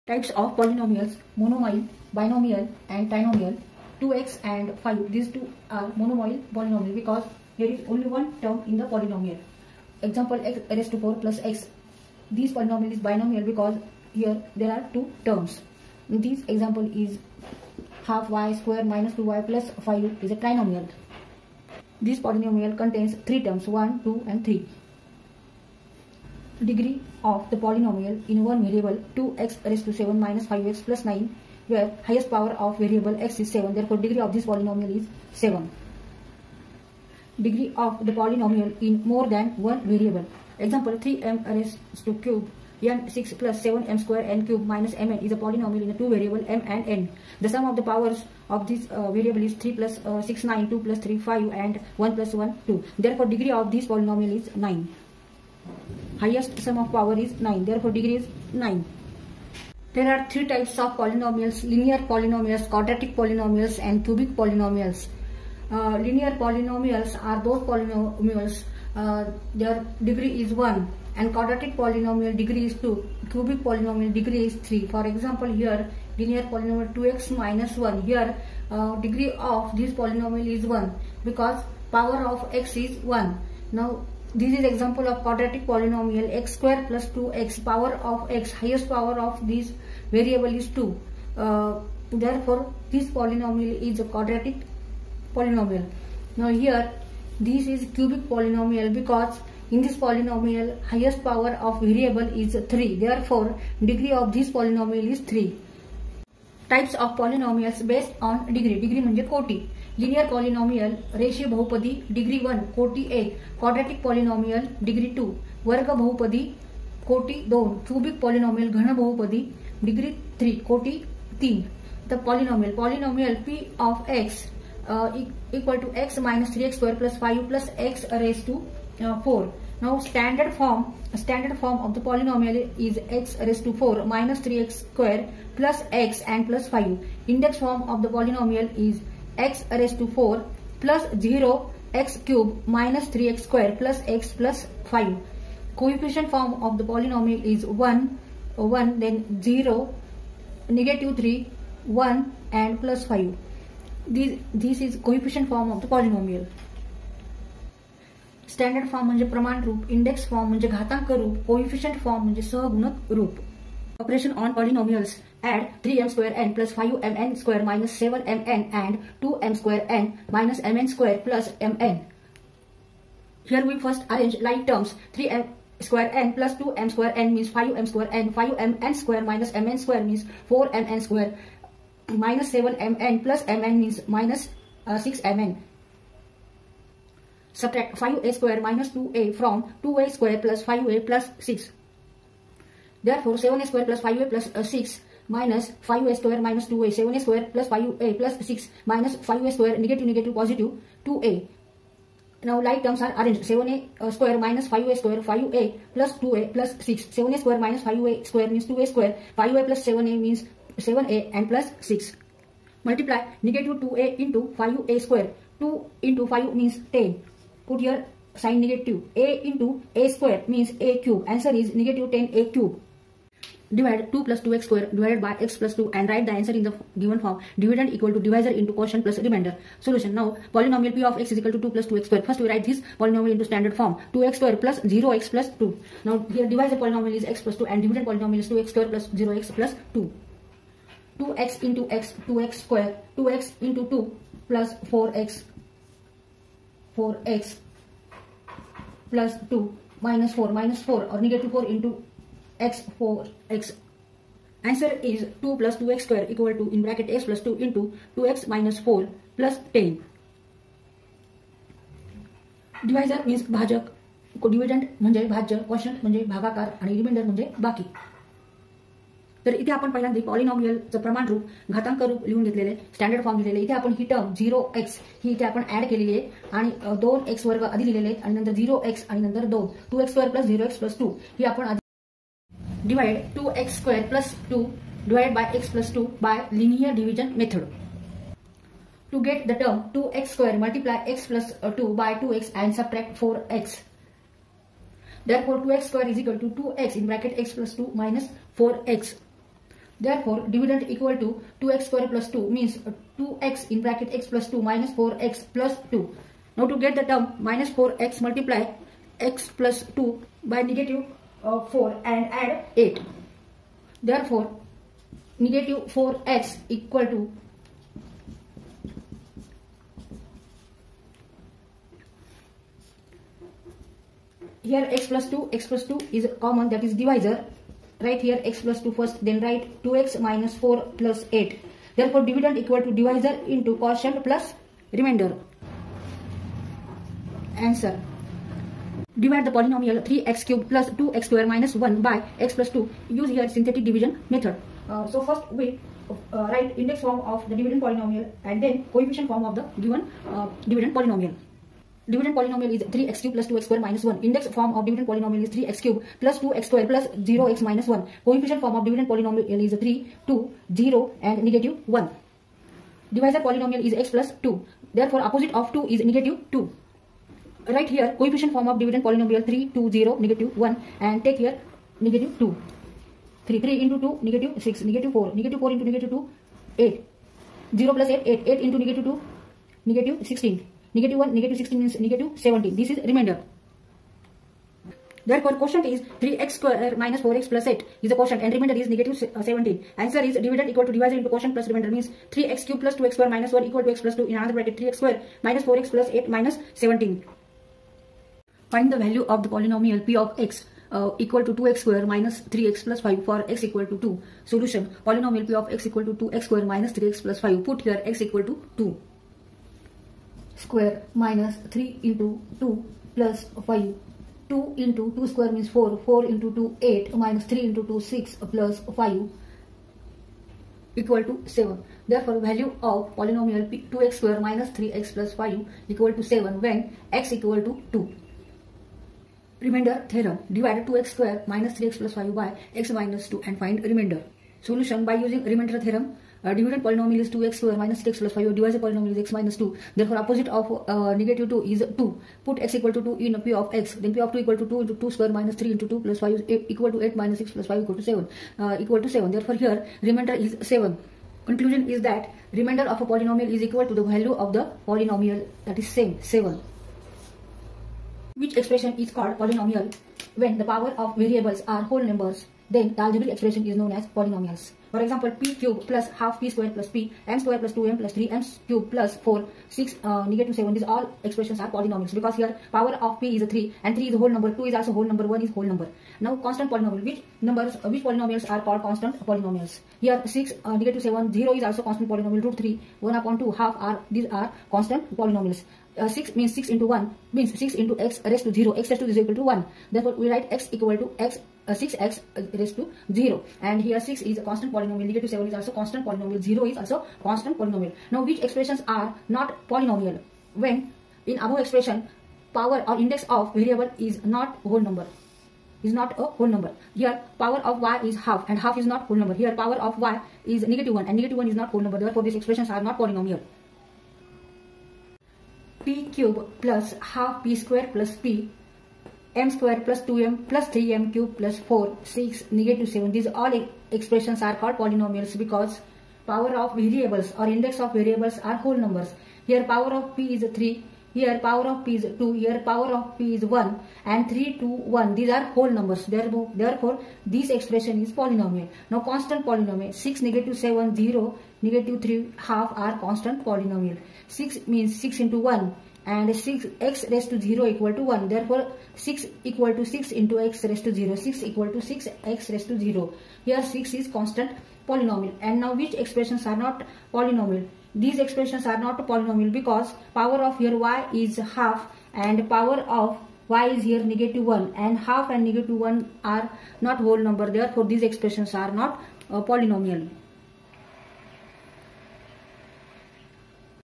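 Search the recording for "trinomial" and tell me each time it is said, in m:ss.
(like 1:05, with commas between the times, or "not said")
0:03, 0:20.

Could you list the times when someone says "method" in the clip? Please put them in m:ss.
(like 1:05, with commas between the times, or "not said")
5:44.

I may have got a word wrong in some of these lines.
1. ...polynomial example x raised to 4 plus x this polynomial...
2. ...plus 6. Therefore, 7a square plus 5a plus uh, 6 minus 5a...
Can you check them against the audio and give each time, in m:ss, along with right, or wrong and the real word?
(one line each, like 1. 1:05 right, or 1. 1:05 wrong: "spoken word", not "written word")
1. 0:08 right
2. 3:11 right.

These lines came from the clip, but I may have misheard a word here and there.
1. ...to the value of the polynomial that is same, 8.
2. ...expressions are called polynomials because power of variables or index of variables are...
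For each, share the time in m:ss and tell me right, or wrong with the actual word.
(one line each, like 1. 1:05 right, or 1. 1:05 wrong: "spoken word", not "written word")
1. 7:33 wrong: "7", not "8"
2. 8:43 right.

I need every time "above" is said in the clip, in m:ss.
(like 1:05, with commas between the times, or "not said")
8:21.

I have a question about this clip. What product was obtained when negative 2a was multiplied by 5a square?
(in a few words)
Negative 10a cube.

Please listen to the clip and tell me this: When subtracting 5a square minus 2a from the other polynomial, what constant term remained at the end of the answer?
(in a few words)
6.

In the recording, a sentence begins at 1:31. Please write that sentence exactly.
Uh, therefore, this polynomial is a quadratic polynomial.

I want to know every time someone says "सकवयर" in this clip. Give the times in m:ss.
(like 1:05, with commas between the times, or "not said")
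2:06, 4:16.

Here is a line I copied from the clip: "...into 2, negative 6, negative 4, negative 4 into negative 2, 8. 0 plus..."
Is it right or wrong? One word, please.
right.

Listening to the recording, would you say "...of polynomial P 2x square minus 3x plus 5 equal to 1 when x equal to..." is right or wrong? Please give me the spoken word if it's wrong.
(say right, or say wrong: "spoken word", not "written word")
wrong: "7", not "1".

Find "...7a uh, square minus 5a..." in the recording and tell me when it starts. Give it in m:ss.
3:23.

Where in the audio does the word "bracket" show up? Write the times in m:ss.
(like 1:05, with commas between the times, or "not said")
4:57, 5:03, 6:34.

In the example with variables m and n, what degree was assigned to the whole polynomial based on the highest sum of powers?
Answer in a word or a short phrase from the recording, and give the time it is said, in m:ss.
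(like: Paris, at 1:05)
9, at 0:52.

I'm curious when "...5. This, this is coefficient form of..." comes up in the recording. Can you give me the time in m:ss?
2:33.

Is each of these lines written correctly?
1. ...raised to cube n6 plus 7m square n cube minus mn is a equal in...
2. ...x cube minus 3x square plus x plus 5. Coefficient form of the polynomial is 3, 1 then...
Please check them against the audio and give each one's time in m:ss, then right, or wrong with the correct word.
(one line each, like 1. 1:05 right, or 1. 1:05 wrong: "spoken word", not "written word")
1. 0:41 wrong: "polynomial", not "equal"
2. 2:21 wrong: "1", not "3".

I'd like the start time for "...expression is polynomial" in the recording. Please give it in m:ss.
8:57.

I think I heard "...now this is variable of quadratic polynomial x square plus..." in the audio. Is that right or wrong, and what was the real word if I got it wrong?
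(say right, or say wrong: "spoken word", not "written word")
wrong: "example", not "variable".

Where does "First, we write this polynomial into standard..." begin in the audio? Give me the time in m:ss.
3:52.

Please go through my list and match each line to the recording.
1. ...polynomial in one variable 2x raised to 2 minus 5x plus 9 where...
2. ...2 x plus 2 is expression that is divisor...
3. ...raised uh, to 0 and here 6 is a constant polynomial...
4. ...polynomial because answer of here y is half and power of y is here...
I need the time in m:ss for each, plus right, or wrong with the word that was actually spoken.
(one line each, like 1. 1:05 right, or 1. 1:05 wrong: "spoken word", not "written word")
1. 0:27 wrong: "7", not "2"
2. 5:25 wrong: "common", not "expression"
3. 8:12 right
4. 9:19 wrong: "power", not "answer".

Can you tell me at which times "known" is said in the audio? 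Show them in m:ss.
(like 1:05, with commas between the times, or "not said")
7:43.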